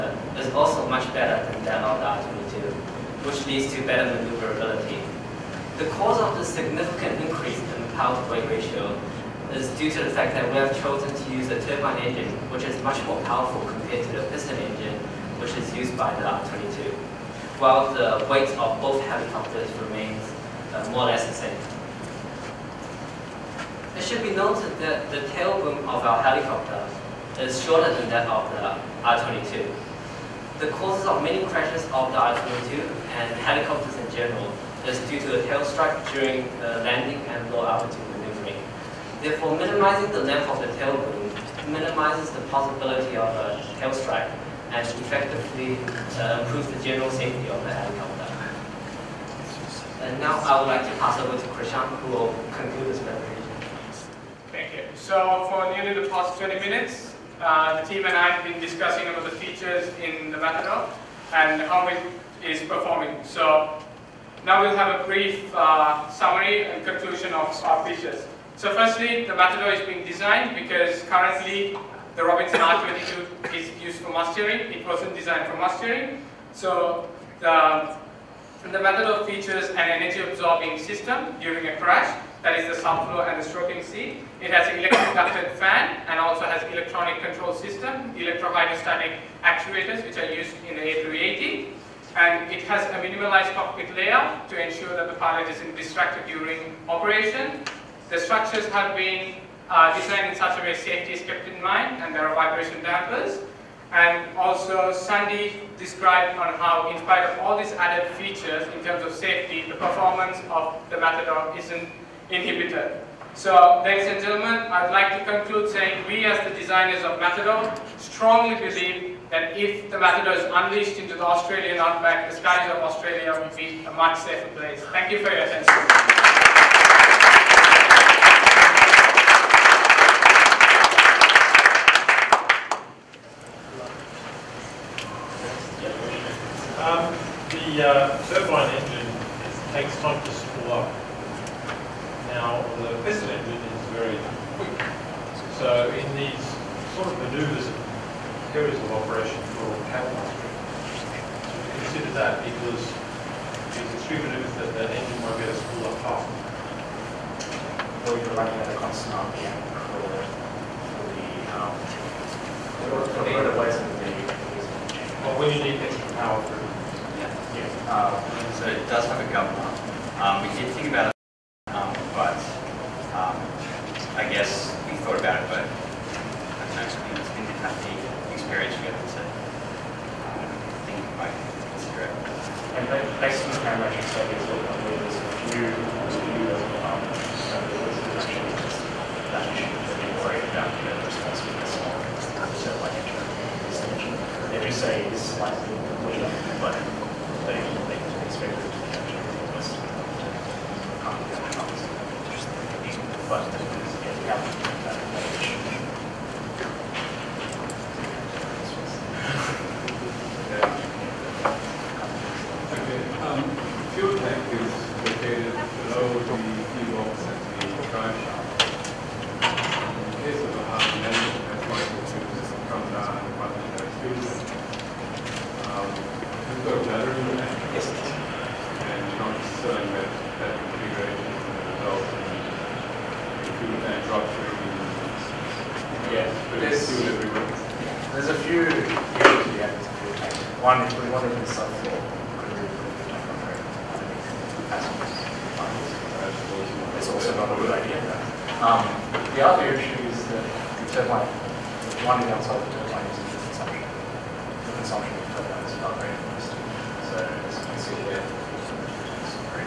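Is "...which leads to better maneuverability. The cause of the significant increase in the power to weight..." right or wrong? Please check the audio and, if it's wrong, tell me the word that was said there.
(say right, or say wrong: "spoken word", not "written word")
right.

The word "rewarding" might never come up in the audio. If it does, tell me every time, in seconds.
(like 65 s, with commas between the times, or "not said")
not said.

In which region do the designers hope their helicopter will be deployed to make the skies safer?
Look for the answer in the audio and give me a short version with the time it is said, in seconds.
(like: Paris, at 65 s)
Australian outback, at 121 s.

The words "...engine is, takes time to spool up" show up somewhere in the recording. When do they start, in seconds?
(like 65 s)
138 s.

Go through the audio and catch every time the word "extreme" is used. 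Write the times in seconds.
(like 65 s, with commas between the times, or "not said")
153 s.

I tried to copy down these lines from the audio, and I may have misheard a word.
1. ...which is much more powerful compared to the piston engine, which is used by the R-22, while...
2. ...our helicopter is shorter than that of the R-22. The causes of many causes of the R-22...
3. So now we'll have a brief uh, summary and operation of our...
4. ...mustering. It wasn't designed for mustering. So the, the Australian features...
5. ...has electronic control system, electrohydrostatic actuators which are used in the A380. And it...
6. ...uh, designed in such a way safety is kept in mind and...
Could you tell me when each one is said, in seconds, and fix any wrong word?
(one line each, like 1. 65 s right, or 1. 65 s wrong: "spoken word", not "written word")
1. 12 s right
2. 26 s wrong: "crashes", not "causes"
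3. 63 s wrong: "conclusion", not "operation"
4. 74 s wrong: "Matador", not "Australian"
5. 86 s right
6. 99 s right.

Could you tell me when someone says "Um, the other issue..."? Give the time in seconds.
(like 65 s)
248 s.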